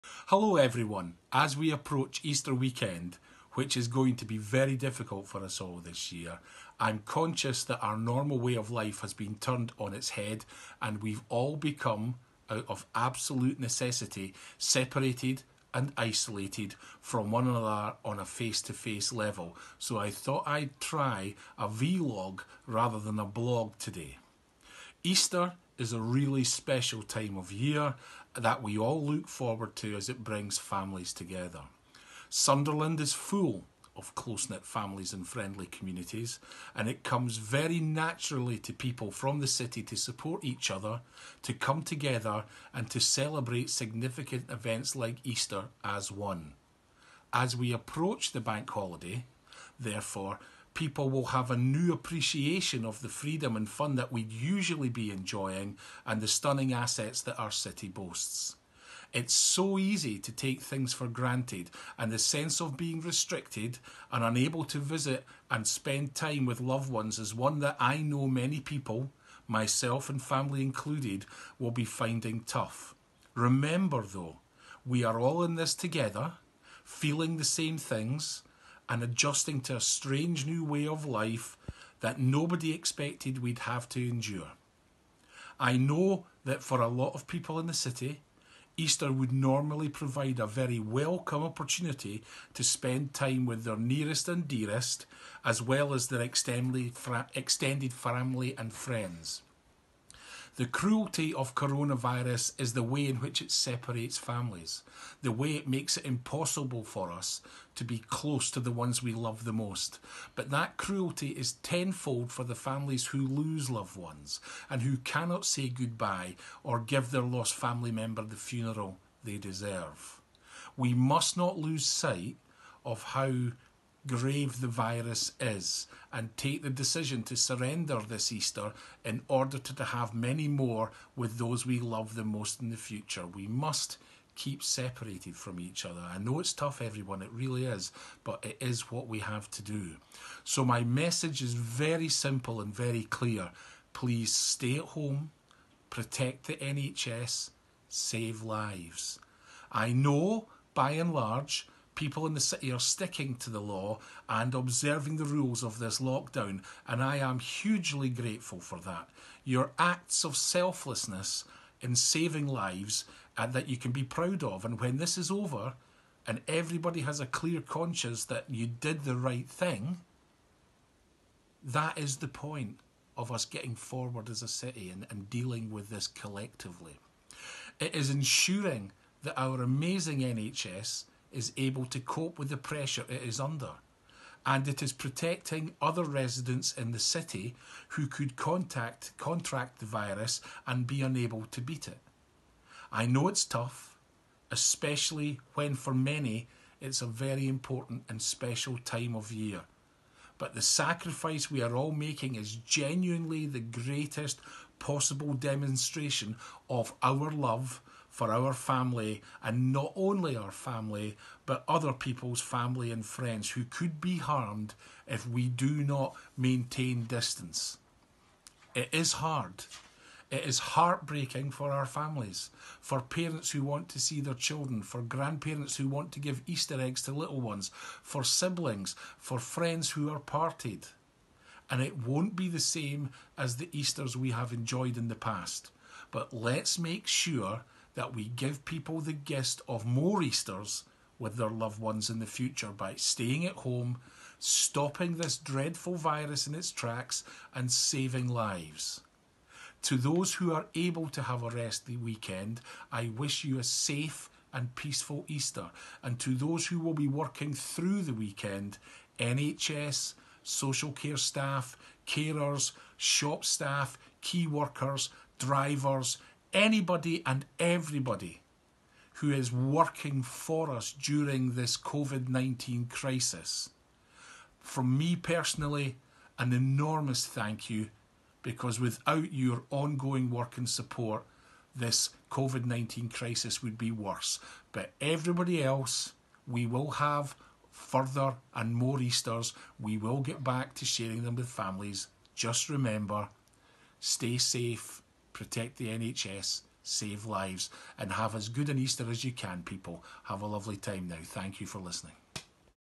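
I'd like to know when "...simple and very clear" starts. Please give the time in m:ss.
2:22.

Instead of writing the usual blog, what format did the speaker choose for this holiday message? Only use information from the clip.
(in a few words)
vlog.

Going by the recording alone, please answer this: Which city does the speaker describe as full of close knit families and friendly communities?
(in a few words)
Sunderland.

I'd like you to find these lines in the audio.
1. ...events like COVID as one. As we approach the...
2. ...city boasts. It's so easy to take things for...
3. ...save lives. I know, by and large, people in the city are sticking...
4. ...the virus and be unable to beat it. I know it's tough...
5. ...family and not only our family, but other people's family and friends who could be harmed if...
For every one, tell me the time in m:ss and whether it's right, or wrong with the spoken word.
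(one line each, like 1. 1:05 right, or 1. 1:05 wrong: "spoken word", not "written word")
1. 0:44 wrong: "Easter", not "COVID"
2. 0:57 right
3. 2:27 right
4. 3:09 right
5. 3:28 right.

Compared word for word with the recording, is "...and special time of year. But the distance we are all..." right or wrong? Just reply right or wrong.
wrong.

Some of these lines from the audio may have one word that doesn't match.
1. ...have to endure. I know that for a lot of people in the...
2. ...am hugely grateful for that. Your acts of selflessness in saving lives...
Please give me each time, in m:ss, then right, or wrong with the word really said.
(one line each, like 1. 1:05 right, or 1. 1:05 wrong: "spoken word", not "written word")
1. 1:23 right
2. 2:37 right.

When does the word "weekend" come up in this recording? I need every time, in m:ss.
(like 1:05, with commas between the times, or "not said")
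0:02, 4:11, 4:18.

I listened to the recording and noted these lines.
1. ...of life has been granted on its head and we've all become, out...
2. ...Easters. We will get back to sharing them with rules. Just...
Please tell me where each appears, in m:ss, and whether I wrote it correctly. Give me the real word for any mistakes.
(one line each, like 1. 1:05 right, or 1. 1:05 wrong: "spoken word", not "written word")
1. 0:08 wrong: "turned", not "granted"
2. 4:49 wrong: "families", not "rules".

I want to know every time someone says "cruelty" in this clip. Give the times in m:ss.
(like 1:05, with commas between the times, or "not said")
1:40, 1:50.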